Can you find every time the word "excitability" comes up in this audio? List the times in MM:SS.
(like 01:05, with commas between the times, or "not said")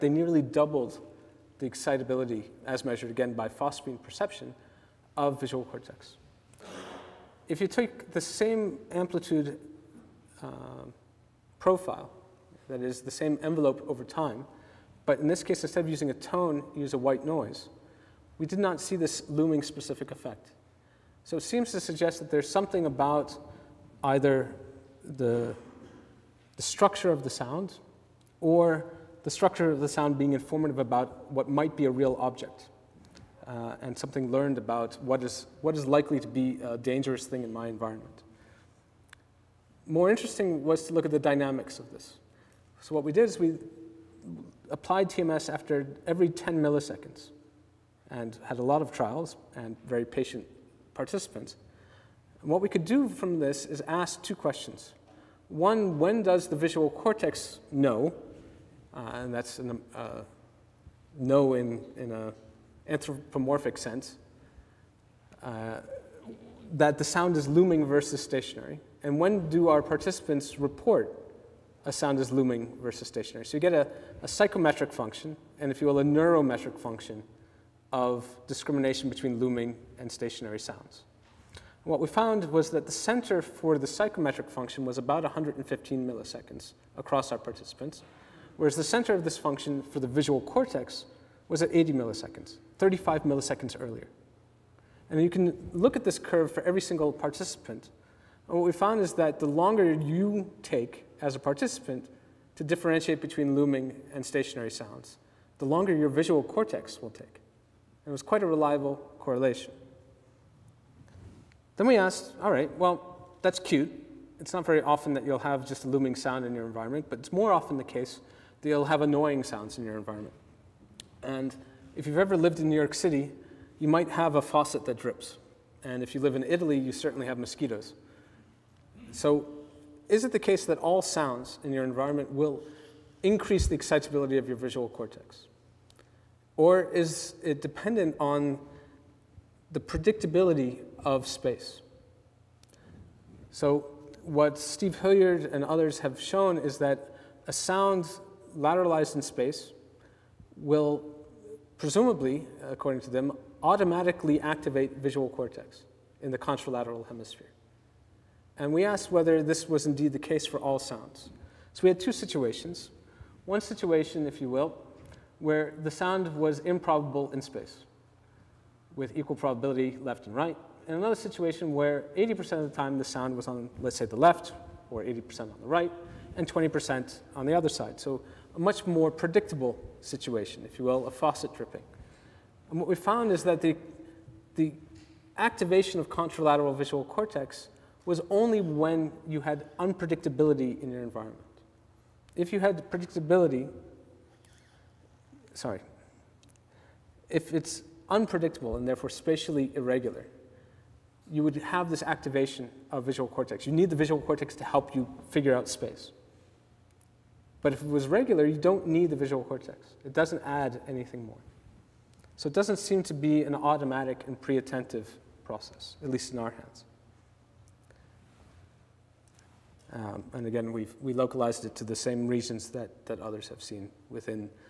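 00:01, 02:13.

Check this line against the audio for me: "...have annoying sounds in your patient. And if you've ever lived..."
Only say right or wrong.
wrong.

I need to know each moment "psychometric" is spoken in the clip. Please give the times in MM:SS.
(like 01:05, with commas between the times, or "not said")
01:14, 01:23.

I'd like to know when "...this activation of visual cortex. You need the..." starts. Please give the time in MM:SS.
03:21.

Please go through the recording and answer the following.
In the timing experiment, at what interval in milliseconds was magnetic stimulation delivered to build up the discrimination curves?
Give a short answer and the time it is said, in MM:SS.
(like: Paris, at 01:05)
10 milliseconds, at 00:46.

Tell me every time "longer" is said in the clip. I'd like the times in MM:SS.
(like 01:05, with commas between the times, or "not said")
01:39, 01:45.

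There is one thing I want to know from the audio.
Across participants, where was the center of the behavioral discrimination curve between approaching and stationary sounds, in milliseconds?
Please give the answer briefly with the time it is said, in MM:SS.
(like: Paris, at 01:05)
115 milliseconds, at 01:25.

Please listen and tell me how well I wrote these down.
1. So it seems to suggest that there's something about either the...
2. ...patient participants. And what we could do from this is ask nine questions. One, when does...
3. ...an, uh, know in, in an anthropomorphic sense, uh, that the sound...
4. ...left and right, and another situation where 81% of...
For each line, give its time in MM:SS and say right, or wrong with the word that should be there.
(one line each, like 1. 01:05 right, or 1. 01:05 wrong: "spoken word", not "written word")
1. 00:21 right
2. 00:50 wrong: "two", not "nine"
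3. 00:59 right
4. 02:50 wrong: "80", not "81".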